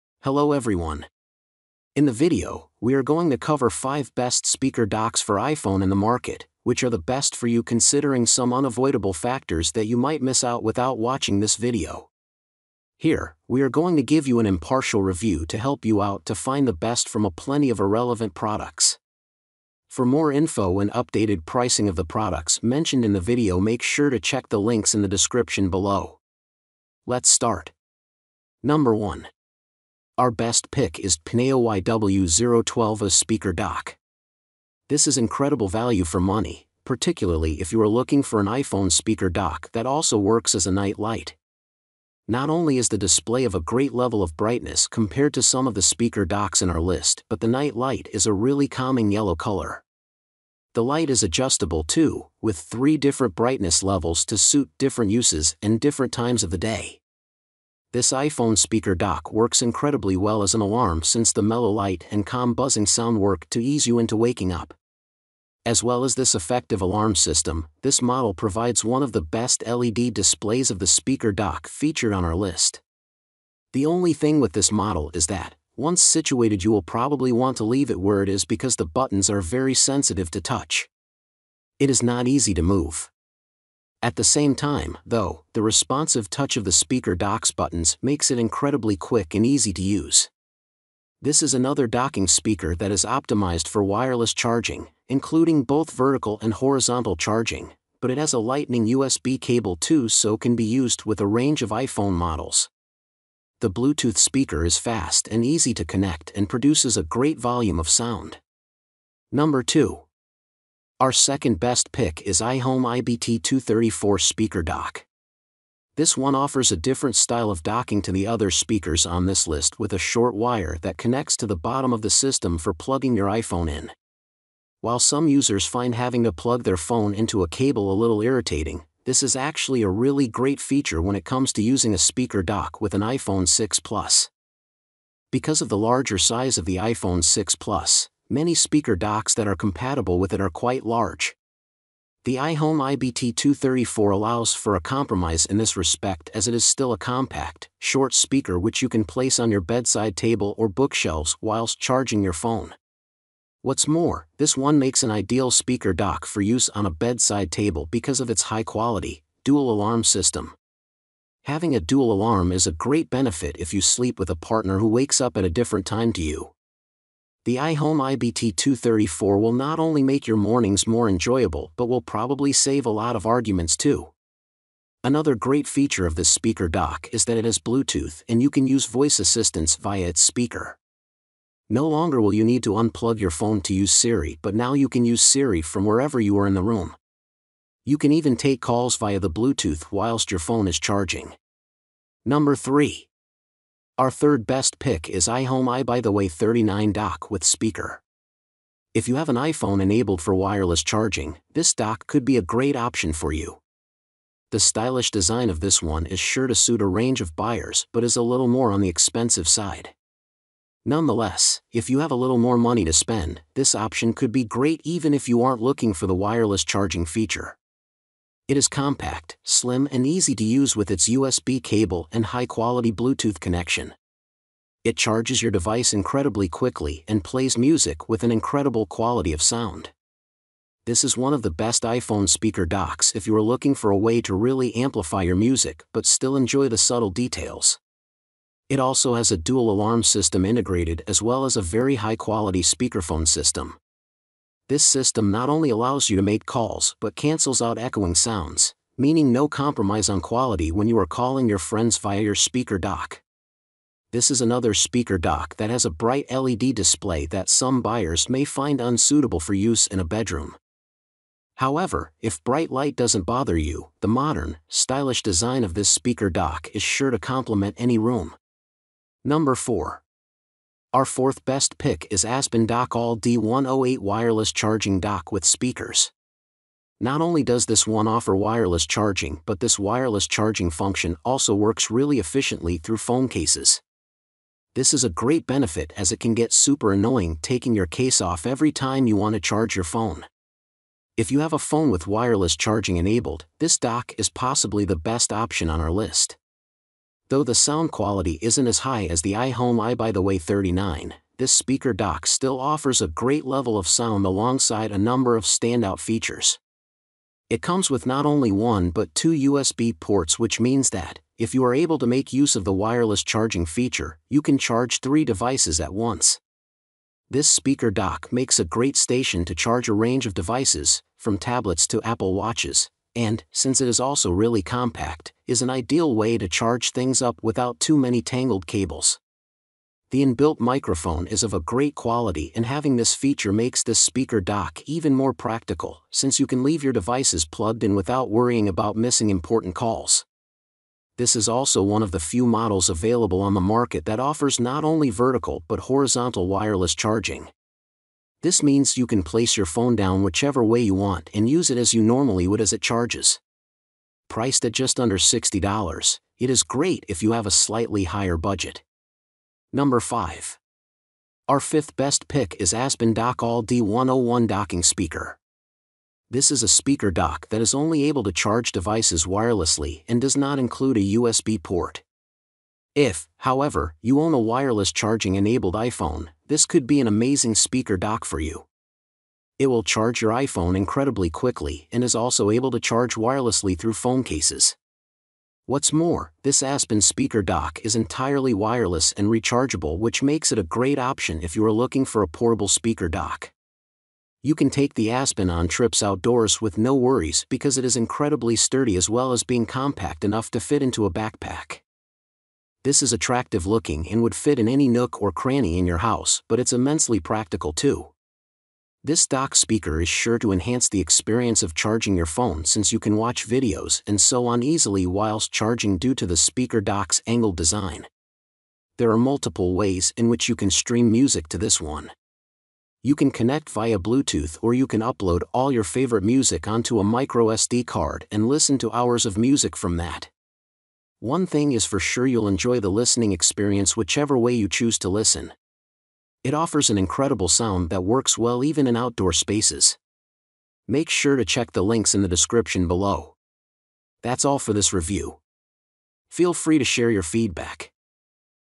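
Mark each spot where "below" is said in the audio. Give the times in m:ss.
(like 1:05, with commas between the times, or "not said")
0:25, 7:22.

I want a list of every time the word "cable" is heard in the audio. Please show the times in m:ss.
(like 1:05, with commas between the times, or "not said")
1:39, 2:07, 3:41, 5:28.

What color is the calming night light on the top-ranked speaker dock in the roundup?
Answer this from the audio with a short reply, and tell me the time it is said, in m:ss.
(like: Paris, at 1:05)
Yellow, at 0:49.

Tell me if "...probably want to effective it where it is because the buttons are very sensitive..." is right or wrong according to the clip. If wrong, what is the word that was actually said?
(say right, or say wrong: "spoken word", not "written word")
wrong: "leave", not "effective".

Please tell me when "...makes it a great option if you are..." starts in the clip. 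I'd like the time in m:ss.
6:30.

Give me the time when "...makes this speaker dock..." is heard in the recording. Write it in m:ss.
5:33.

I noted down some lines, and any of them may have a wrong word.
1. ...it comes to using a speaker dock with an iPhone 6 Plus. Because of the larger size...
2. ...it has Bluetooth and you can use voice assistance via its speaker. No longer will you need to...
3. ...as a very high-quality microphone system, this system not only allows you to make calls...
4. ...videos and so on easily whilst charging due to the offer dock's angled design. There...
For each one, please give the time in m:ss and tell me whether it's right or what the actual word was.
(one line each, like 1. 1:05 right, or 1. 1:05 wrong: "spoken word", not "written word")
1. 2:11 right
2. 2:57 right
3. 4:01 wrong: "speakerphone", not "microphone"
4. 6:53 wrong: "speaker", not "offer".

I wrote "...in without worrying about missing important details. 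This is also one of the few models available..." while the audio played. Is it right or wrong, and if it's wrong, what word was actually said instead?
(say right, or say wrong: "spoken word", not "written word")
wrong: "calls", not "details".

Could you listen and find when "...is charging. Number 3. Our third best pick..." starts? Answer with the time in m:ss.
3:10.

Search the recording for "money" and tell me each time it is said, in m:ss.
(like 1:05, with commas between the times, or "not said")
0:36, 3:32.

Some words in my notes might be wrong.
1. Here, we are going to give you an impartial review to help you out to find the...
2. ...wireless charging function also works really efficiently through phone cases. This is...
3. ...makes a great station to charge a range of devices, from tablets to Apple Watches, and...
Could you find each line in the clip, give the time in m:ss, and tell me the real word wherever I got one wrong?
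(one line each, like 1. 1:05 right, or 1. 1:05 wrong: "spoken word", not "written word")
1. 0:12 right
2. 4:39 right
3. 5:18 right.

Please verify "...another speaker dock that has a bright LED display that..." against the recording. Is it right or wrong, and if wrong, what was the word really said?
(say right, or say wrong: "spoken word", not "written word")
right.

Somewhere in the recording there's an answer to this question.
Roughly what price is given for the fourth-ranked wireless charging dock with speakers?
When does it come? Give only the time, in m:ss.
5:54.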